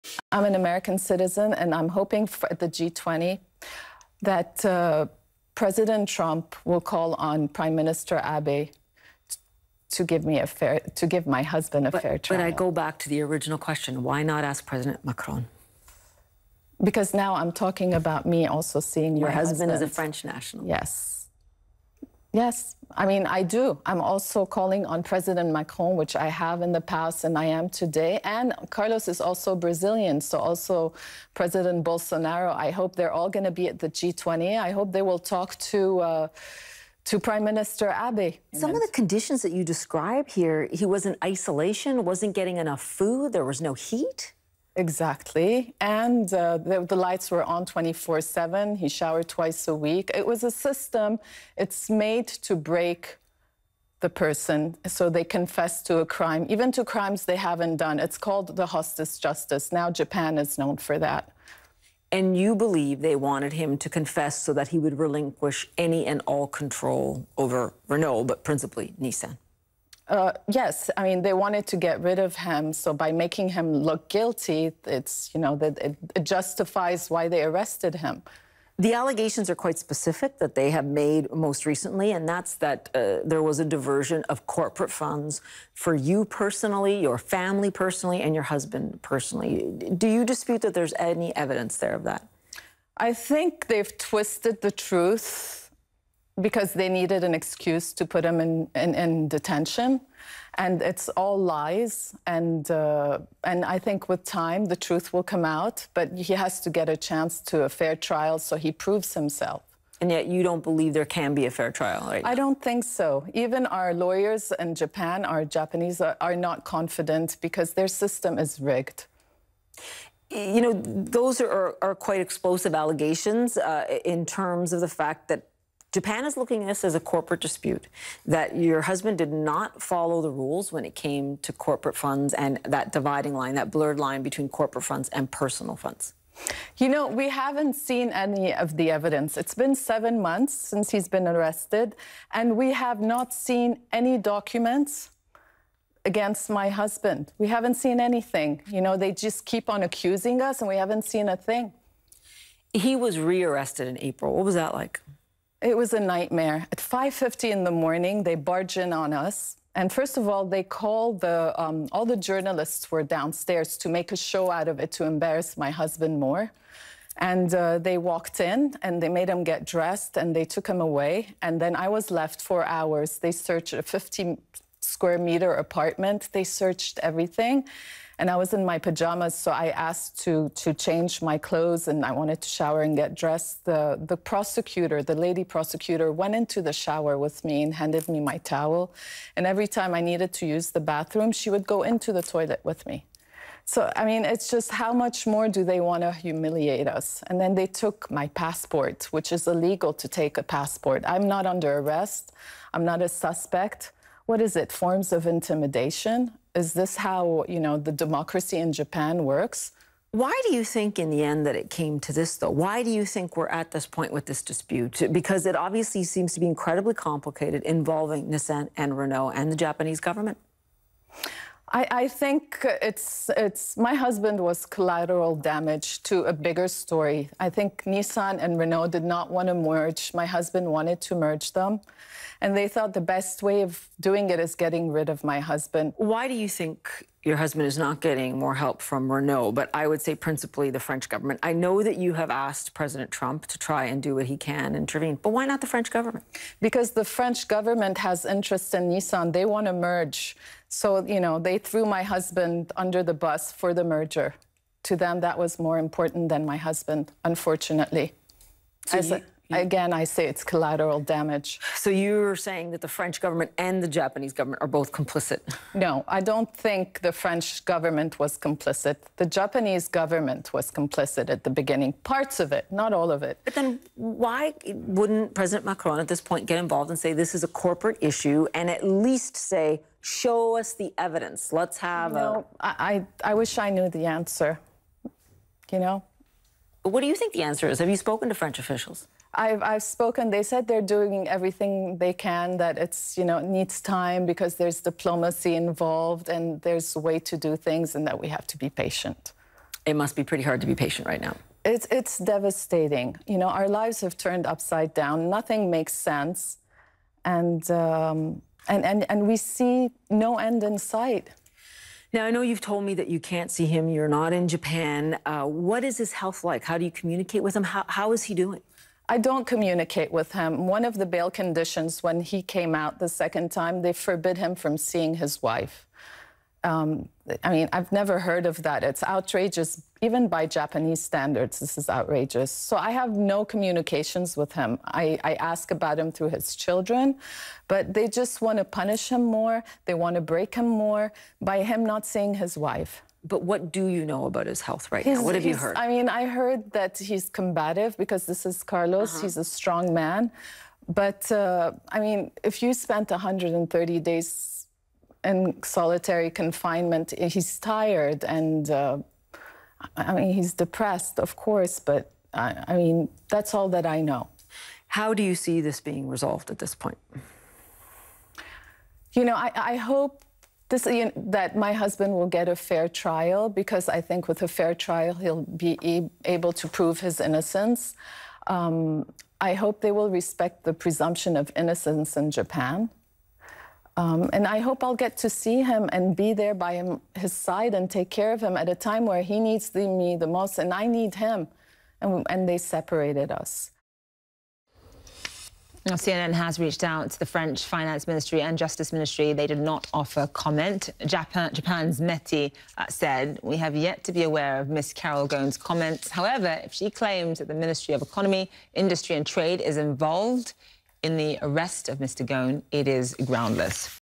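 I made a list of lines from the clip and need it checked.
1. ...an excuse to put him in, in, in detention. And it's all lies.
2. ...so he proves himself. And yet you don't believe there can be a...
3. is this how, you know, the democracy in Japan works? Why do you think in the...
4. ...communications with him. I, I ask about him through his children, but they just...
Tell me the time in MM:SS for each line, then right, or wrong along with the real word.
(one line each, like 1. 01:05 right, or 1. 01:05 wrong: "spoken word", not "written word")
1. 01:37 right
2. 01:48 right
3. 03:26 right
4. 05:33 right.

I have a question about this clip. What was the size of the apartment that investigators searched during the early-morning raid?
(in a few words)
50 square meters.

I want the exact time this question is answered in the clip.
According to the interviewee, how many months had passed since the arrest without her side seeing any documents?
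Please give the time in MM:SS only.
02:19.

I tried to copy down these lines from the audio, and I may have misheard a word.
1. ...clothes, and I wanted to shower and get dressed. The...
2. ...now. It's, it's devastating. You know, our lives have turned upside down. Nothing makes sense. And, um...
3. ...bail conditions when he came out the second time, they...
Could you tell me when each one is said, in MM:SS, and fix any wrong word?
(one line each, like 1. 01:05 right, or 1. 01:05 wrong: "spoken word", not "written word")
1. 03:01 right
2. 05:01 right
3. 05:21 right.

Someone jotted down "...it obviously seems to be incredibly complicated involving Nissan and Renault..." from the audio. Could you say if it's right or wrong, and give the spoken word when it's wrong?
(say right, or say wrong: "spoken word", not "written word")
right.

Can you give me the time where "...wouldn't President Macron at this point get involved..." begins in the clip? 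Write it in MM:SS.
04:34.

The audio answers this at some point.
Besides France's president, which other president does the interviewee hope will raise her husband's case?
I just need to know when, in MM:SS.
00:31.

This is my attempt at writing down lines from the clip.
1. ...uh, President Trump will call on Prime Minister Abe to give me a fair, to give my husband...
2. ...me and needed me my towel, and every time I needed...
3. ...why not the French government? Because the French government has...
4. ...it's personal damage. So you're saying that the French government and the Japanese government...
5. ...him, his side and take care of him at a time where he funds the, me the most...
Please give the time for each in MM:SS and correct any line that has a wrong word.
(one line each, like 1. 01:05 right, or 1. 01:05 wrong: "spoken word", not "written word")
1. 00:04 right
2. 03:07 wrong: "handed", not "needed"
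3. 04:05 right
4. 04:20 wrong: "collateral", not "personal"
5. 06:26 wrong: "needs", not "funds".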